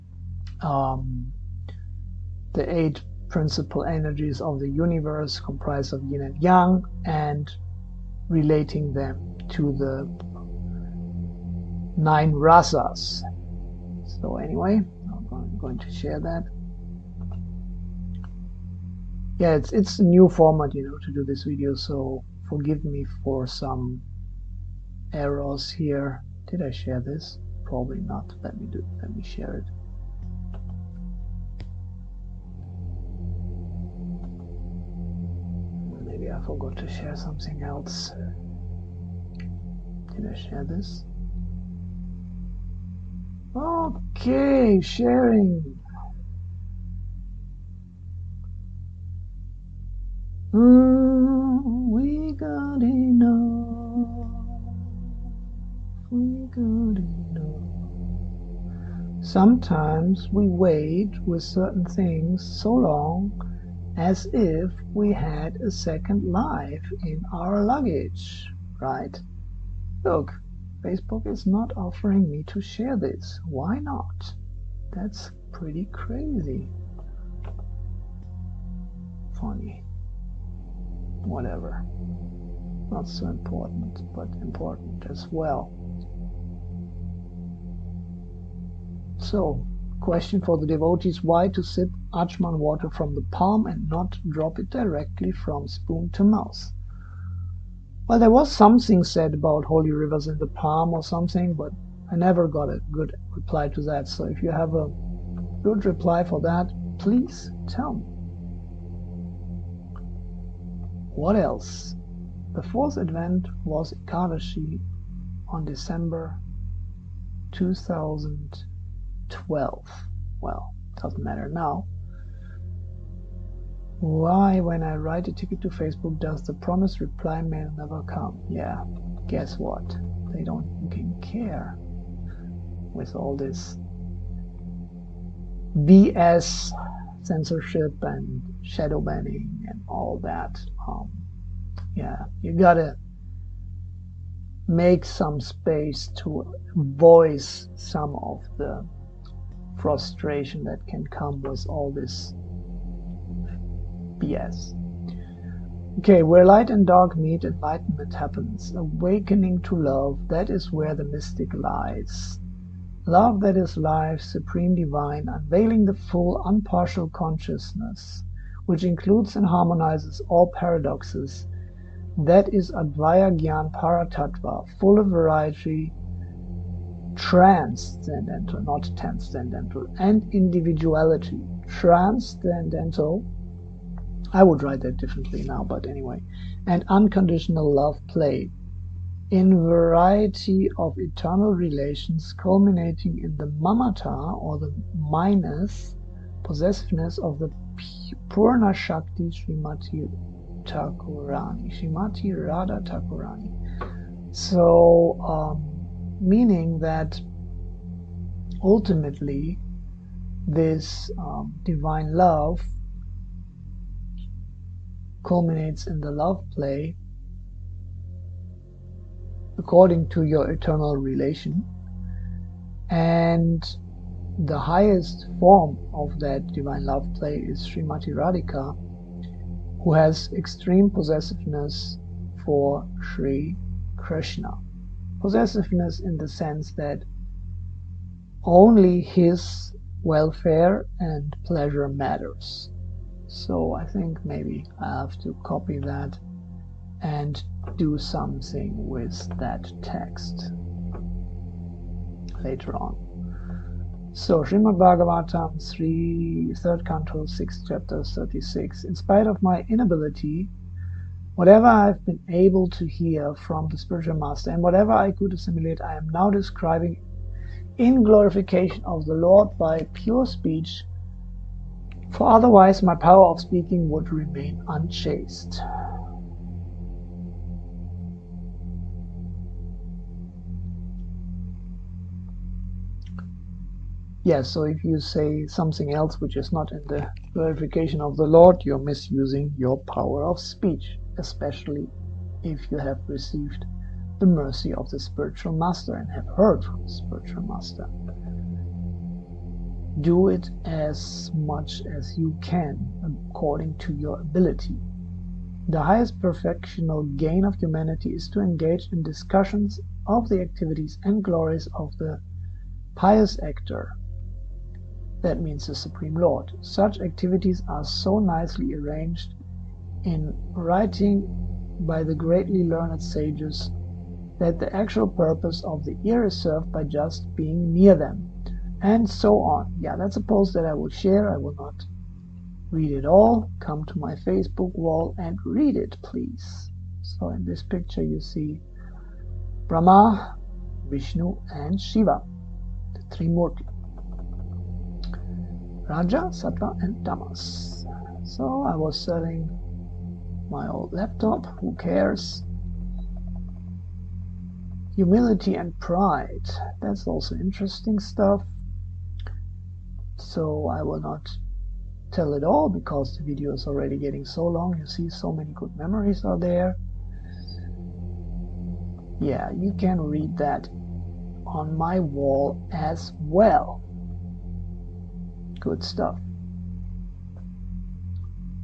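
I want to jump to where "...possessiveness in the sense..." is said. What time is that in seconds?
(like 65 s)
235 s.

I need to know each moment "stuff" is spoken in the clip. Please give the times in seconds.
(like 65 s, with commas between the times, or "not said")
358 s, 375 s.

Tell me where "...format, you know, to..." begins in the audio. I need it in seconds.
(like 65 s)
20 s.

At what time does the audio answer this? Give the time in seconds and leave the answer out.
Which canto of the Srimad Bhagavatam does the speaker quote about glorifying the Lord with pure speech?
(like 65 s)
256 s.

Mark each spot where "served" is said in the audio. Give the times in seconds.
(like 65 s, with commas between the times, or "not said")
326 s.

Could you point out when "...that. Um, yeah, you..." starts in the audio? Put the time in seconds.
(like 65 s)
140 s.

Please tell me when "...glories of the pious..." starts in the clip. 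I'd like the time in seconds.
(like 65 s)
311 s.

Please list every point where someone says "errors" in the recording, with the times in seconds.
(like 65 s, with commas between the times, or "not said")
25 s.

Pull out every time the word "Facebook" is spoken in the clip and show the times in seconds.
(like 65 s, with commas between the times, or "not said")
70 s, 125 s, 334 s.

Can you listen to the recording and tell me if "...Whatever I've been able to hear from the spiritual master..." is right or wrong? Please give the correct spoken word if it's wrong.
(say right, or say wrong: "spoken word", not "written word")
right.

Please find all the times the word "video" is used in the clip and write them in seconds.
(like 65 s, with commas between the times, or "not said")
21 s, 363 s.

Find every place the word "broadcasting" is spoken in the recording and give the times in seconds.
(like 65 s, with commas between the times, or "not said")
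not said.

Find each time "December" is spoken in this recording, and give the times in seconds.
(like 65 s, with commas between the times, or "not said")
115 s.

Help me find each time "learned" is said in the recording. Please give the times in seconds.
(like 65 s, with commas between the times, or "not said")
322 s.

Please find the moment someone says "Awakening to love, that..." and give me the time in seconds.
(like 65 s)
158 s.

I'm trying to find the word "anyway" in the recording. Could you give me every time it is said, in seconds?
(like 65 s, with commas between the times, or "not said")
14 s, 185 s.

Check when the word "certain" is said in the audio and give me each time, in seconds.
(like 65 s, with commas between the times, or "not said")
61 s.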